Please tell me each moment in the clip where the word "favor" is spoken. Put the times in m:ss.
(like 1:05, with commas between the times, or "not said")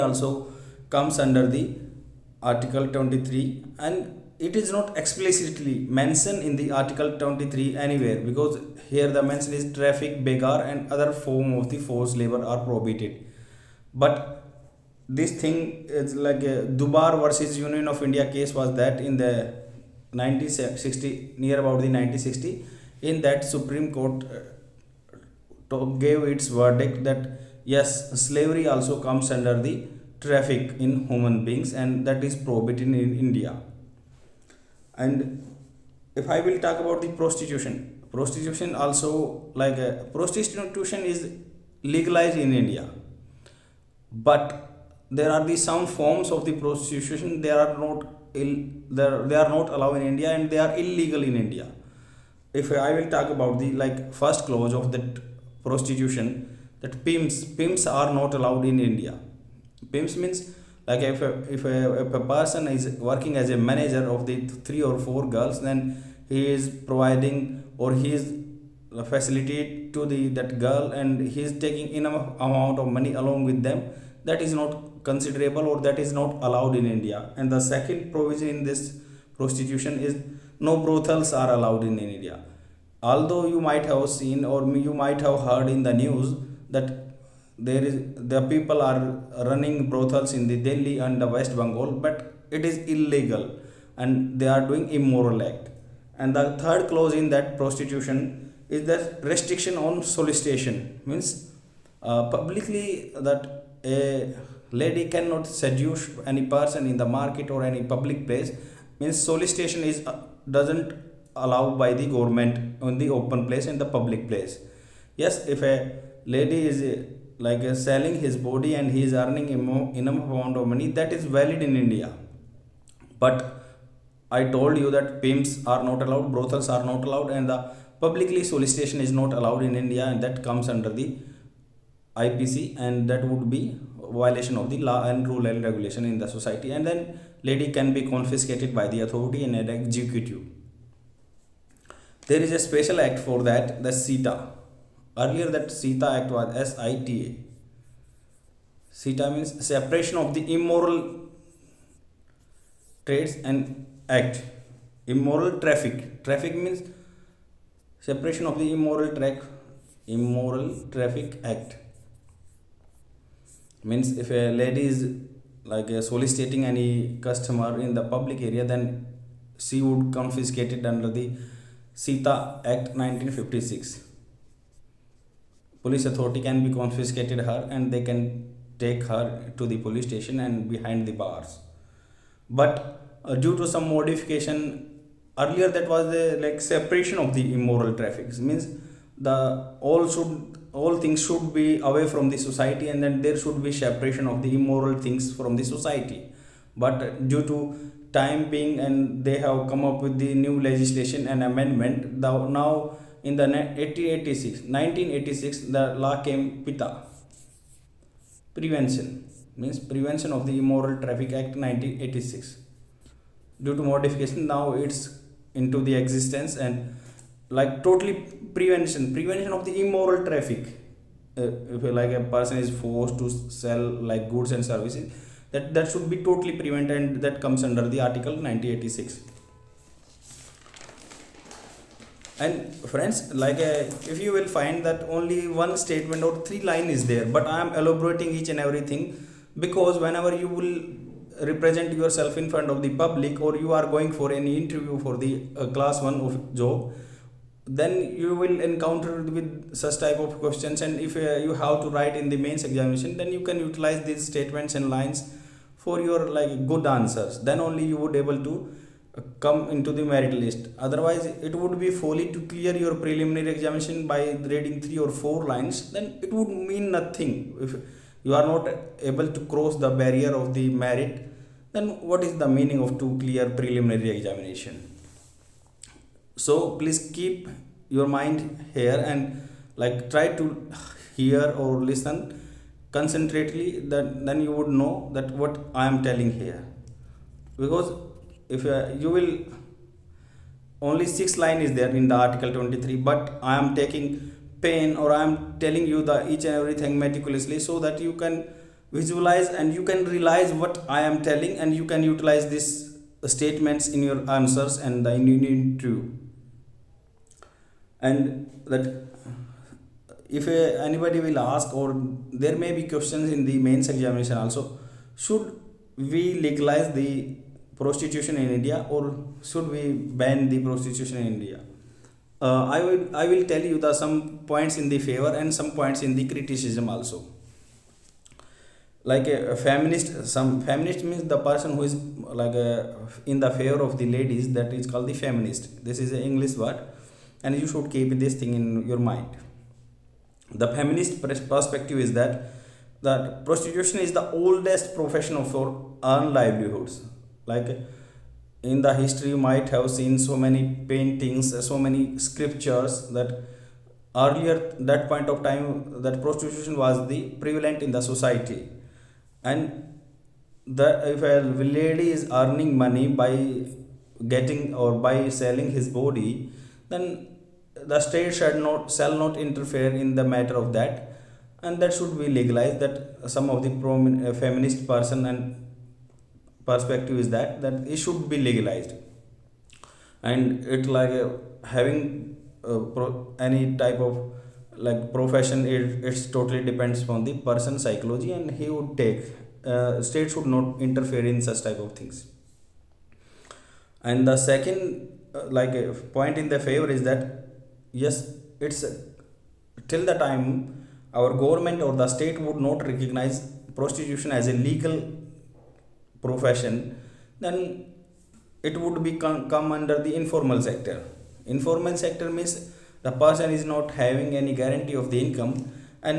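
5:25, 5:33, 6:36.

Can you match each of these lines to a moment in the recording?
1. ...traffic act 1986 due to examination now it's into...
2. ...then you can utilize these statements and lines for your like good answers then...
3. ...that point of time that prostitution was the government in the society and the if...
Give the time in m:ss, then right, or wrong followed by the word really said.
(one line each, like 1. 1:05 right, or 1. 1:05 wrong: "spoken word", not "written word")
1. 3:31 wrong: "modification", not "examination"
2. 4:13 right
3. 5:54 wrong: "prevalent", not "government".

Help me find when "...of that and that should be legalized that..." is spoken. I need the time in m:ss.
6:10.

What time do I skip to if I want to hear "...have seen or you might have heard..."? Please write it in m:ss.
1:23.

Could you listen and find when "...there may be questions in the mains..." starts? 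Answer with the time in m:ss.
5:12.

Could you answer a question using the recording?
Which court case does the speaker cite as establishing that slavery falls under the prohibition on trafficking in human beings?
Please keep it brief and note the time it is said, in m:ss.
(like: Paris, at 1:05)
Dubar versus Union of India, at 0:16.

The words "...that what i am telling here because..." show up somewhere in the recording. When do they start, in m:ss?
4:45.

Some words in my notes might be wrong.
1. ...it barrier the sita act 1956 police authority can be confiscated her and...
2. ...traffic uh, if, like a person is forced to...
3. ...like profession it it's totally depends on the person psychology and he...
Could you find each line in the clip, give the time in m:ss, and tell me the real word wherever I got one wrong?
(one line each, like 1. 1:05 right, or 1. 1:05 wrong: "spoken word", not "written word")
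1. 2:50 wrong: "under", not "barrier"
2. 3:40 right
3. 6:24 right.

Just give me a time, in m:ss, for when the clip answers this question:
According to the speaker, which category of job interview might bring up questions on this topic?
4:05.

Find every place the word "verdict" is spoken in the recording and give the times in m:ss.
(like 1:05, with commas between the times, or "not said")
0:26.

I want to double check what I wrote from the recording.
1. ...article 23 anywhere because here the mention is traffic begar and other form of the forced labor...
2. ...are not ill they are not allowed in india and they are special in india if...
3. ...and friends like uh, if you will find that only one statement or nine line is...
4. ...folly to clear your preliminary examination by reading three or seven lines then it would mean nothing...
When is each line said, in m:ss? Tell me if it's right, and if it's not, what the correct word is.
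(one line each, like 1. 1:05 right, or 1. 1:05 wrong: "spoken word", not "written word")
1. 0:06 right
2. 0:47 wrong: "illegal", not "special"
3. 3:52 wrong: "three", not "nine"
4. 4:21 wrong: "four", not "seven".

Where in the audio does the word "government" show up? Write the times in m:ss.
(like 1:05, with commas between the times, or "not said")
1:52, 6:41.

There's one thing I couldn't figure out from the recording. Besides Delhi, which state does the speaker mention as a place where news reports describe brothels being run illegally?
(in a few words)
West Bengal.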